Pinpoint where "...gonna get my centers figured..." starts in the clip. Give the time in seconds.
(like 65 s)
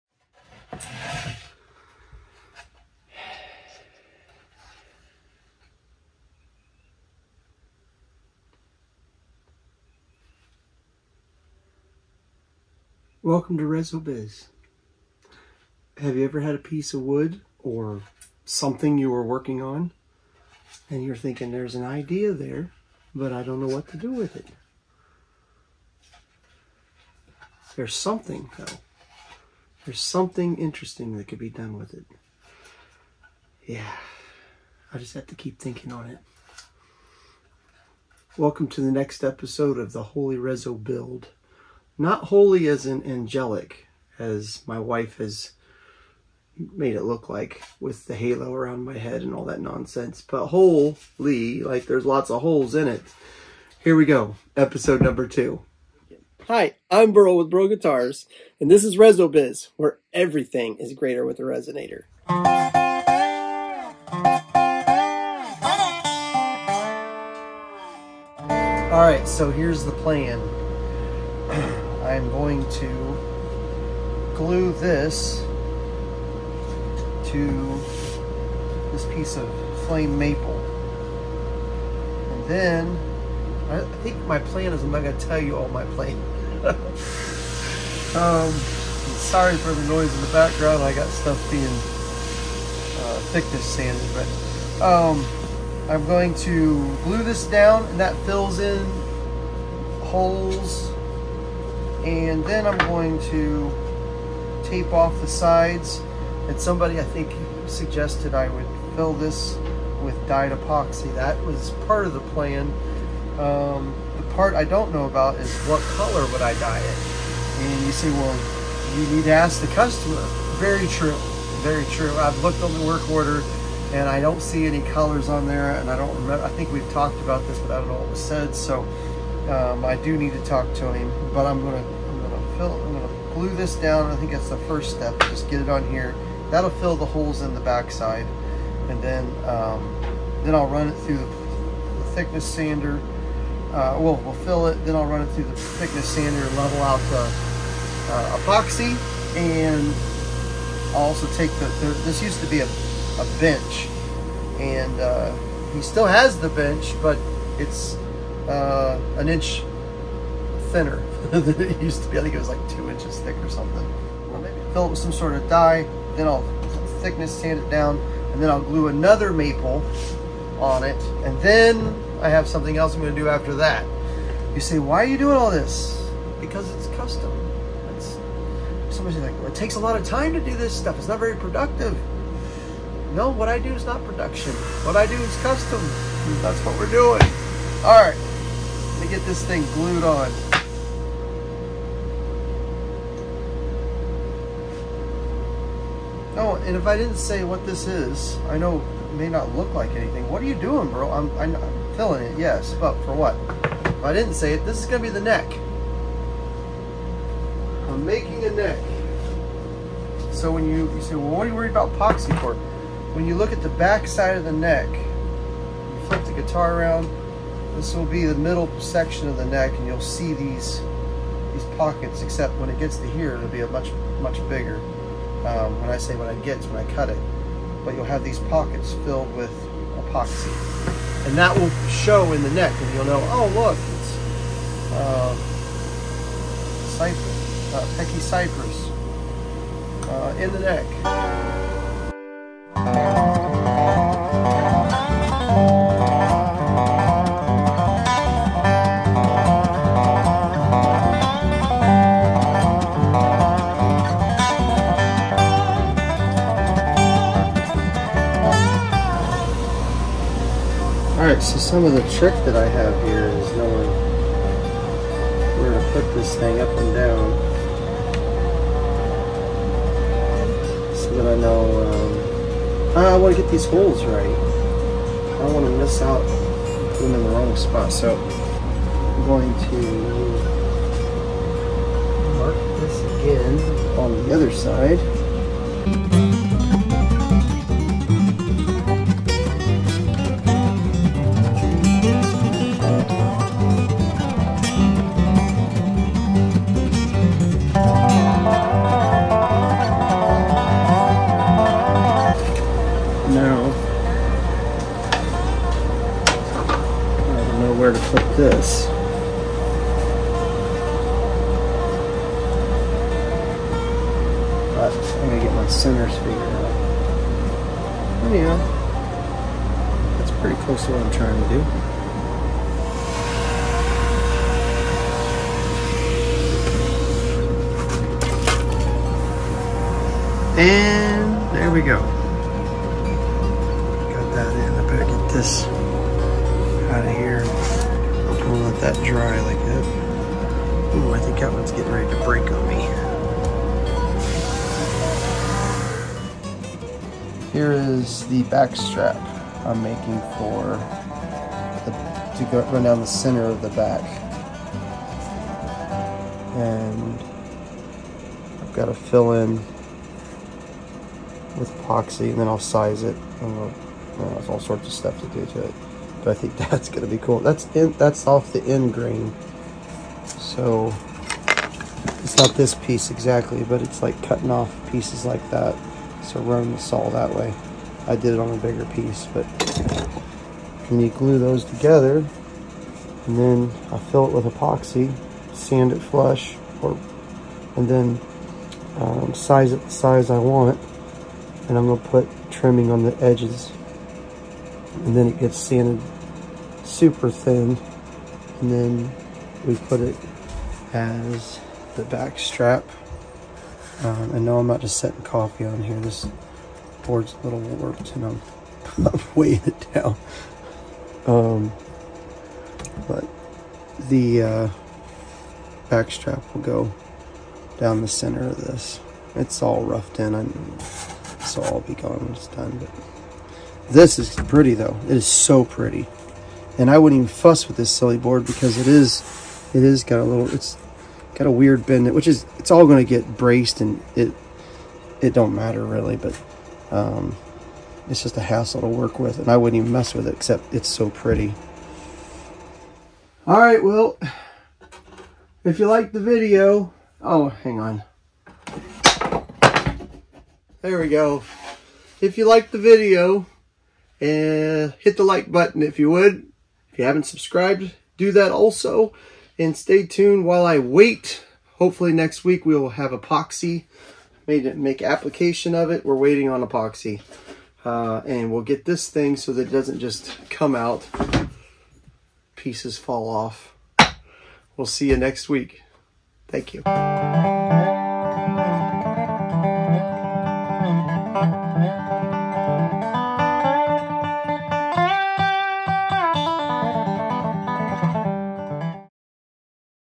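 315 s.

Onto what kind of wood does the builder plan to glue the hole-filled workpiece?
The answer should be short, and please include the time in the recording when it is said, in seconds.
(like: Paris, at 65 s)
flame maple, at 79 s.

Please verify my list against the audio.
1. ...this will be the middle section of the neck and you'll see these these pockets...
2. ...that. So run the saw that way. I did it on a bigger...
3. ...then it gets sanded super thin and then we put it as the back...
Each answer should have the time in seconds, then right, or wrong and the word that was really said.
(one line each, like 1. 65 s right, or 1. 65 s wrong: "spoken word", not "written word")
1. 217 s right
2. 375 s right
3. 395 s right.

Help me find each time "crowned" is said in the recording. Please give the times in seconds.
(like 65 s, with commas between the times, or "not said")
not said.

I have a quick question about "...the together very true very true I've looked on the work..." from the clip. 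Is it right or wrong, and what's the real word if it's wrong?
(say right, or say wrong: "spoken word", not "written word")
wrong: "customer", not "together".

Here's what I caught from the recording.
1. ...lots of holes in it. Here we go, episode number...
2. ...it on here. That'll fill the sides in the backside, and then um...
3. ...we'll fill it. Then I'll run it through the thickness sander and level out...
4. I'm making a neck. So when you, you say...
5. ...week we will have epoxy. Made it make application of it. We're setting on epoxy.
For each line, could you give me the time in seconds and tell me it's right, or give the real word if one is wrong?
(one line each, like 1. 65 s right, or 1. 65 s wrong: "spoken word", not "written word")
1. 52 s right
2. 135 s wrong: "holes", not "sides"
3. 144 s right
4. 207 s right
5. 462 s wrong: "waiting", not "setting".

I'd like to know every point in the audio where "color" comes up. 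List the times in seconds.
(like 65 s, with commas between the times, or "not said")
115 s, 124 s.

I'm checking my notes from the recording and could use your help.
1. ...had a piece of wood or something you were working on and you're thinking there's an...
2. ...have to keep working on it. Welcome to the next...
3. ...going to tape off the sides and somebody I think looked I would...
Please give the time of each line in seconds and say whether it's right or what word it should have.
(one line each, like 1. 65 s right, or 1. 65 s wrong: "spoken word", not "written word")
1. 16 s right
2. 35 s wrong: "thinking", not "working"
3. 102 s wrong: "suggested", not "looked".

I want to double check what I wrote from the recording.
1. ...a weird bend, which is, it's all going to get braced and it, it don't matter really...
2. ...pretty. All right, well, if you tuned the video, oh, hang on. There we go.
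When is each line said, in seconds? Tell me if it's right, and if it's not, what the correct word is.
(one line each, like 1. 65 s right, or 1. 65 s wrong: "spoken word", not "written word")
1. 431 s right
2. 441 s wrong: "liked", not "tuned".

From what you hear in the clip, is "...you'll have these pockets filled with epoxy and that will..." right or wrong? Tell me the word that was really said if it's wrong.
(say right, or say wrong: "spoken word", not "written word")
right.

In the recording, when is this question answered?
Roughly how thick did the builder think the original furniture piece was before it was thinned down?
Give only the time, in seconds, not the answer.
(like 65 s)
162 s.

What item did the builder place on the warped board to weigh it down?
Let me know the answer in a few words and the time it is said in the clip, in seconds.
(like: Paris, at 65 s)
coffee, at 405 s.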